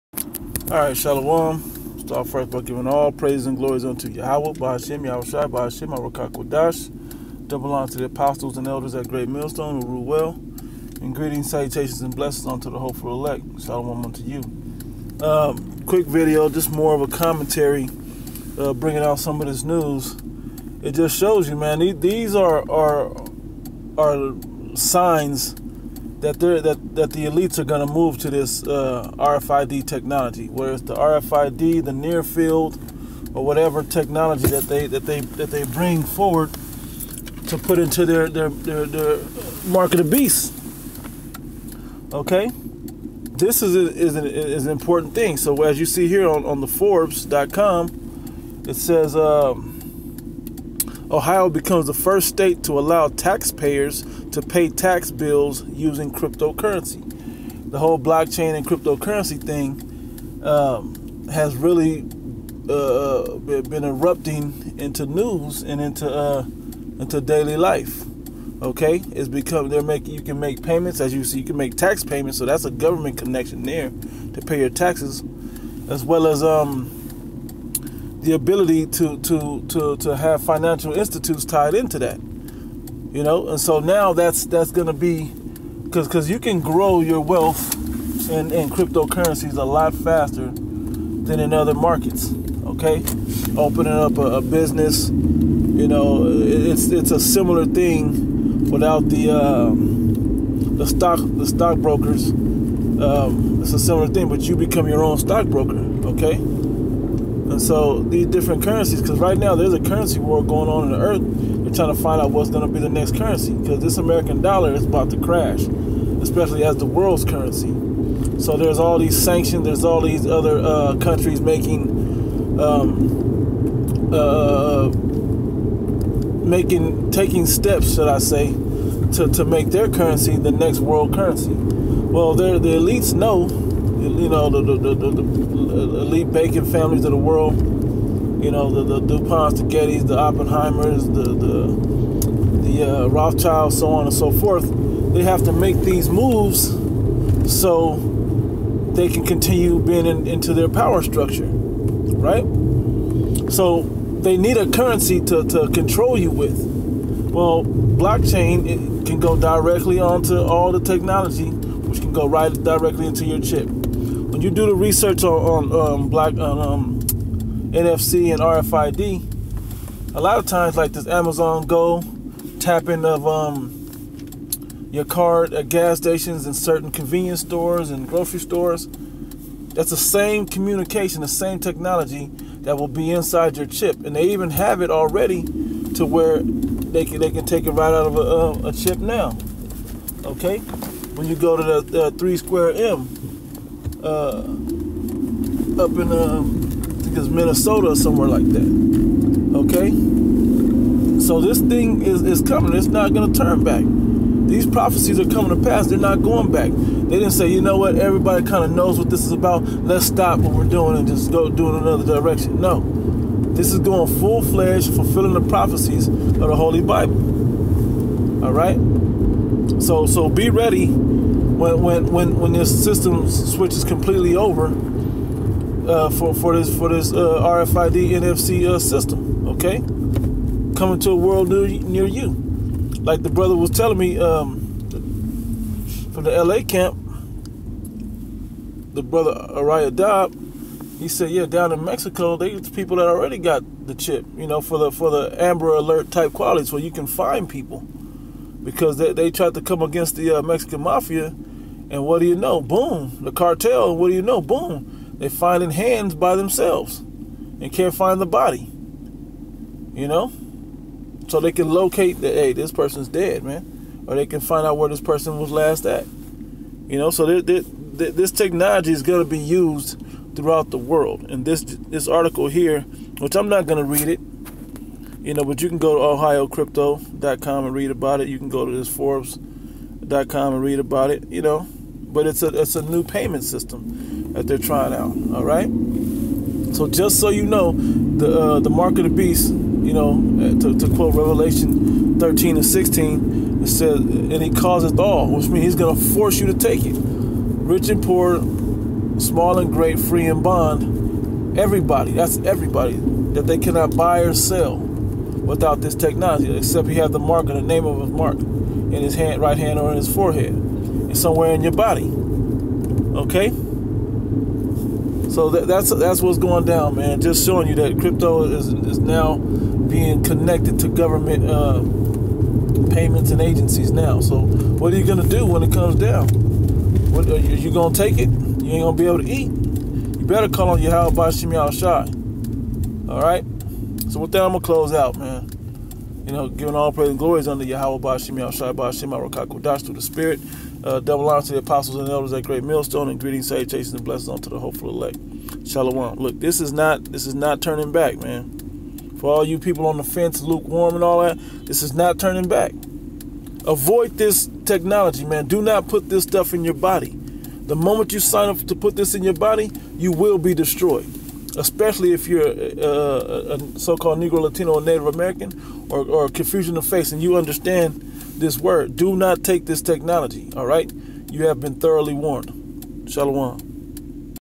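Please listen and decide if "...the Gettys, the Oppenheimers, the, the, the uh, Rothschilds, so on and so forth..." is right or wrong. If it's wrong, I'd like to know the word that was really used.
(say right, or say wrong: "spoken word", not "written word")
right.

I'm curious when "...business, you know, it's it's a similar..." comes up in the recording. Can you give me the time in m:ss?
1:34.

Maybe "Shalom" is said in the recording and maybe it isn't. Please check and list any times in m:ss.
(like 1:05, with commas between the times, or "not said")
0:00, 0:13, 5:45, 6:13.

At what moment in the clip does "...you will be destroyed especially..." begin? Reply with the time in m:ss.
5:59.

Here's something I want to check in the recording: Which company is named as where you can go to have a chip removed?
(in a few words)
3M.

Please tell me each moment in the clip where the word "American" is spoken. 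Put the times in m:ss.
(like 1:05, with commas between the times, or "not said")
1:53, 6:05.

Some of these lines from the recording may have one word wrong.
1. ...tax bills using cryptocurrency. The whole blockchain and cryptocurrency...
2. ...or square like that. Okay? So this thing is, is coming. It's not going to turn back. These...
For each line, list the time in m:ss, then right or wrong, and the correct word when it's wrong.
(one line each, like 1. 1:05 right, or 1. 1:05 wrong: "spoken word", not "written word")
1. 0:54 right
2. 3:17 wrong: "somewhere", not "square".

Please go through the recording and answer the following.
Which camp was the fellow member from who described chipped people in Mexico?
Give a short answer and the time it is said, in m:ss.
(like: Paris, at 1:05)
LA camp, at 3:56.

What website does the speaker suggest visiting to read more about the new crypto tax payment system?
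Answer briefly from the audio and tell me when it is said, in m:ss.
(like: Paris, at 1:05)
ohiocrypto.com, at 4:36.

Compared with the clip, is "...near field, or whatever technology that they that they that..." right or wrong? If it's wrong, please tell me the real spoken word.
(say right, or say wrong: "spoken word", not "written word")
right.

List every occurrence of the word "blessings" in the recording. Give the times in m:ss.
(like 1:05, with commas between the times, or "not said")
0:12, 5:44.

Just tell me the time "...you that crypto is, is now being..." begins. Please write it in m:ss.
5:17.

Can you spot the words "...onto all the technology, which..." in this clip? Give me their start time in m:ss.
2:39.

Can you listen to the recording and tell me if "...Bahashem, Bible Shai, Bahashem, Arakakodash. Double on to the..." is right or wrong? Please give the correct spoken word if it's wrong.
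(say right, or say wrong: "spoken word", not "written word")
wrong: "Yahweh", not "Bible".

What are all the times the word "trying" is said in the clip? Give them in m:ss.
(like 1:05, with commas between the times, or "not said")
1:51, 4:44.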